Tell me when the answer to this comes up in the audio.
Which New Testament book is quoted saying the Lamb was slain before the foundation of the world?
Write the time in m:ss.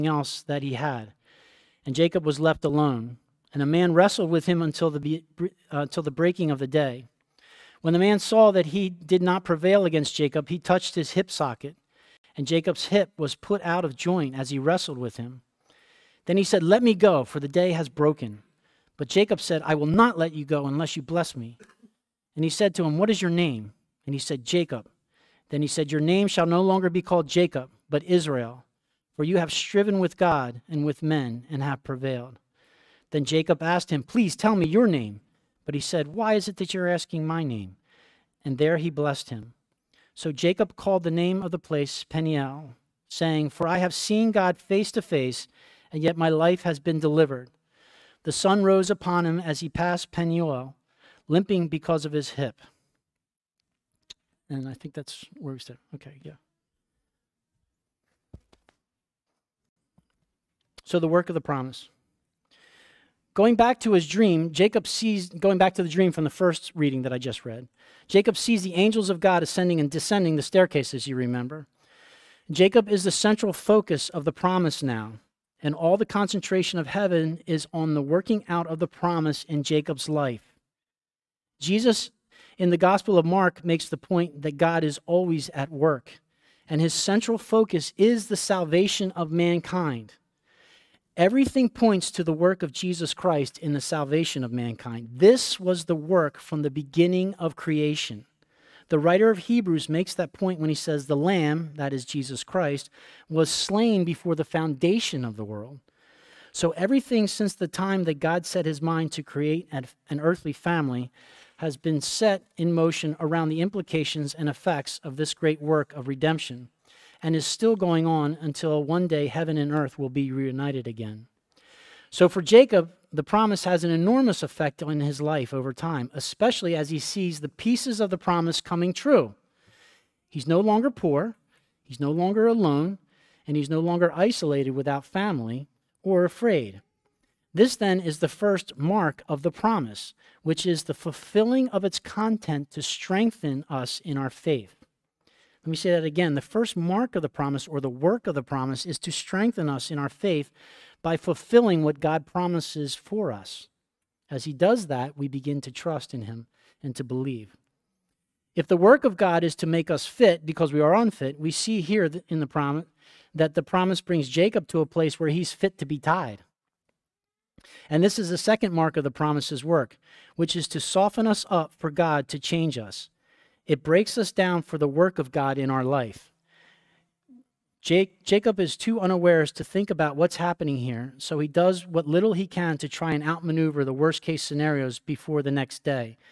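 1:39.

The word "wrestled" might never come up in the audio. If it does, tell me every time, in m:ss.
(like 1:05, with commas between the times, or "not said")
0:03, 0:14.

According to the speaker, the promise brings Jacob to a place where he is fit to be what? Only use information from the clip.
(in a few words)
tied.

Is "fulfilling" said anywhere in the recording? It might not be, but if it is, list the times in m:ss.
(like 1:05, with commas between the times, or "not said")
2:20, 2:31.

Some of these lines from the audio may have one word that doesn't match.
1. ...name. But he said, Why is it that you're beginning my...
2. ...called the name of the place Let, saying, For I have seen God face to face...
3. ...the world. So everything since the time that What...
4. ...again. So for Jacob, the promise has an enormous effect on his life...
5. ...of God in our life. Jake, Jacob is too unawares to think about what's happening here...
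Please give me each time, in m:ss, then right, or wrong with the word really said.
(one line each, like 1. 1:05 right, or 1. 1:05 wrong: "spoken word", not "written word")
1. 0:34 wrong: "asking", not "beginning"
2. 0:40 wrong: "Peniel", not "Let"
3. 1:45 wrong: "God", not "What"
4. 2:00 right
5. 2:55 right.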